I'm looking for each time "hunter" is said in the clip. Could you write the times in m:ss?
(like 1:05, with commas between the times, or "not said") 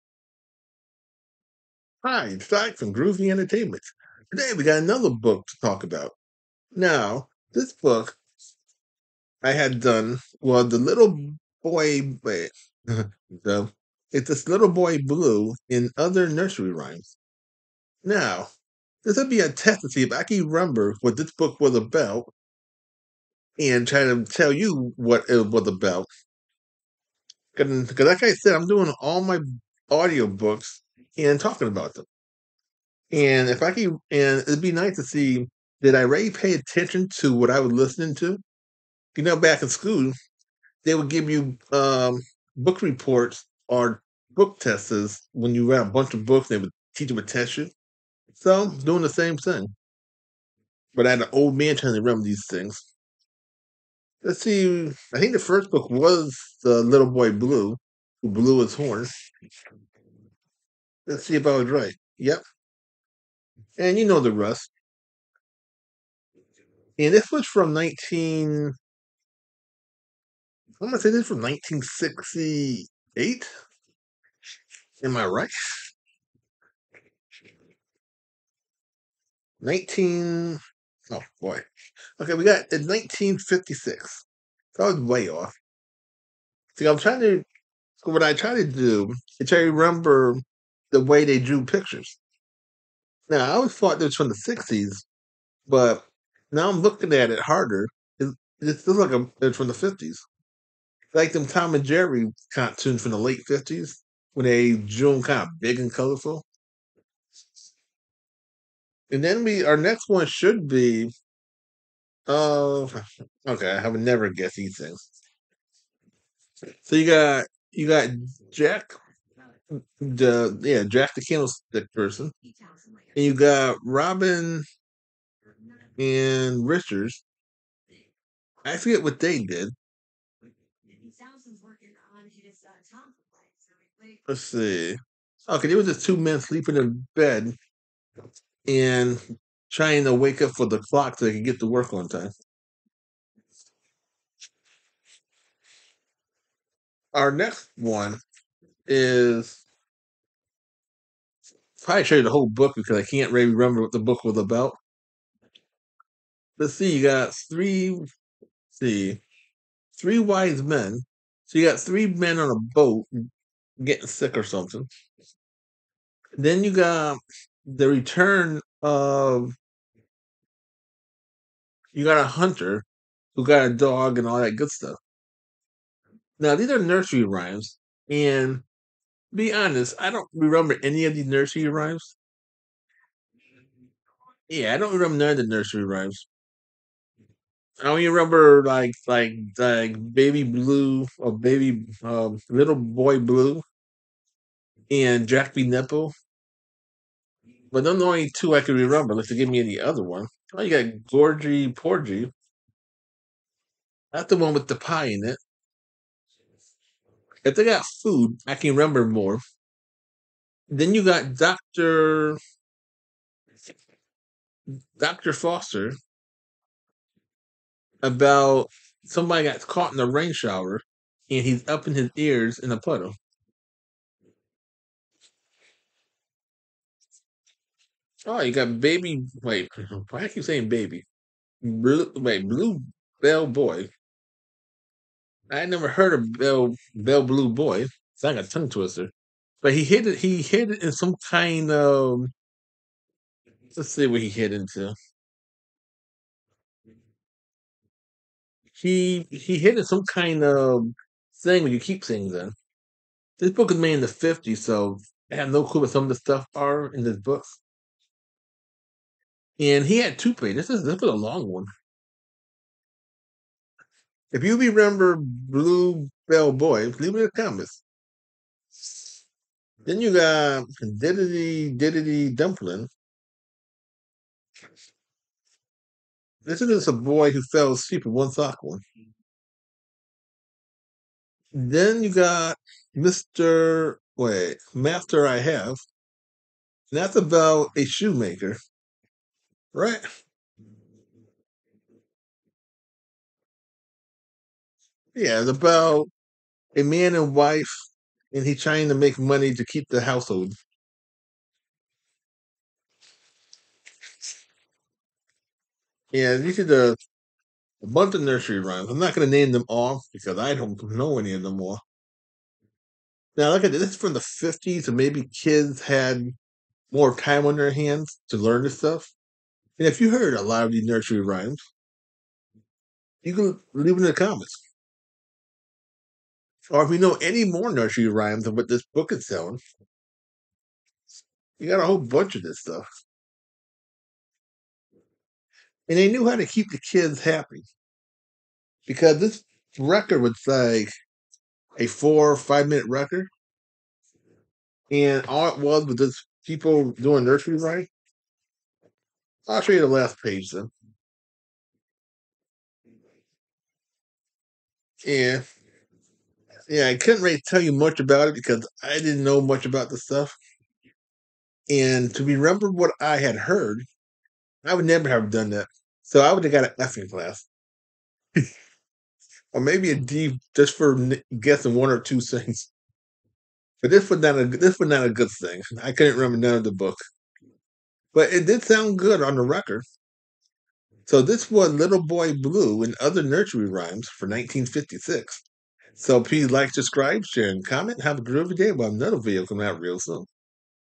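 2:52.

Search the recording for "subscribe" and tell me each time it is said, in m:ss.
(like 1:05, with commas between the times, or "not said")
6:26.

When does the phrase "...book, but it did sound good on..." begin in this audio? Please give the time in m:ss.
6:16.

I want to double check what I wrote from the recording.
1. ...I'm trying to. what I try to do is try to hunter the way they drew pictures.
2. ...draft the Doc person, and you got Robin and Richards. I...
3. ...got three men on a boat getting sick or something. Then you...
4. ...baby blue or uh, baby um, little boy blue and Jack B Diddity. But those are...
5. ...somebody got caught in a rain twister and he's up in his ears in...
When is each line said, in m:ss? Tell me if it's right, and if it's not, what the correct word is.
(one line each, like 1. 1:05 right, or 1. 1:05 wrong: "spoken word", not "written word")
1. 1:26 wrong: "remember", not "hunter"
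2. 2:00 wrong: "Candlestick", not "Doc"
3. 2:41 right
4. 3:10 wrong: "Nipple", not "Diddity"
5. 3:39 wrong: "shower", not "twister".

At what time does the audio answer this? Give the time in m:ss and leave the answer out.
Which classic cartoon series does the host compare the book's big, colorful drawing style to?
1:41.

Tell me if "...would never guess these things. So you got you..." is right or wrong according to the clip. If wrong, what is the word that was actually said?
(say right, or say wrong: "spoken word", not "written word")
right.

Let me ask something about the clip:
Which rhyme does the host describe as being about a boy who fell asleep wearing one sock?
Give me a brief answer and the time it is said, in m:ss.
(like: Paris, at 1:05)
Diddity Diddity Dumpling, at 4:30.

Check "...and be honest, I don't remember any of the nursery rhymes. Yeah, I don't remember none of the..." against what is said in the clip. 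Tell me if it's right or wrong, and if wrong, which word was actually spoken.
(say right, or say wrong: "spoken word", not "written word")
right.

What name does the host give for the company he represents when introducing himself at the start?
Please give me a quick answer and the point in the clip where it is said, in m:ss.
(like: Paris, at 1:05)
Groovy Entertainment, at 0:02.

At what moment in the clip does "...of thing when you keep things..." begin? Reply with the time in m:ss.
4:10.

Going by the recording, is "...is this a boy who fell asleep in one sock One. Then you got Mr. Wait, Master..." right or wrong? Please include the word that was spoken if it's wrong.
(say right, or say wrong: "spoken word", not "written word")
right.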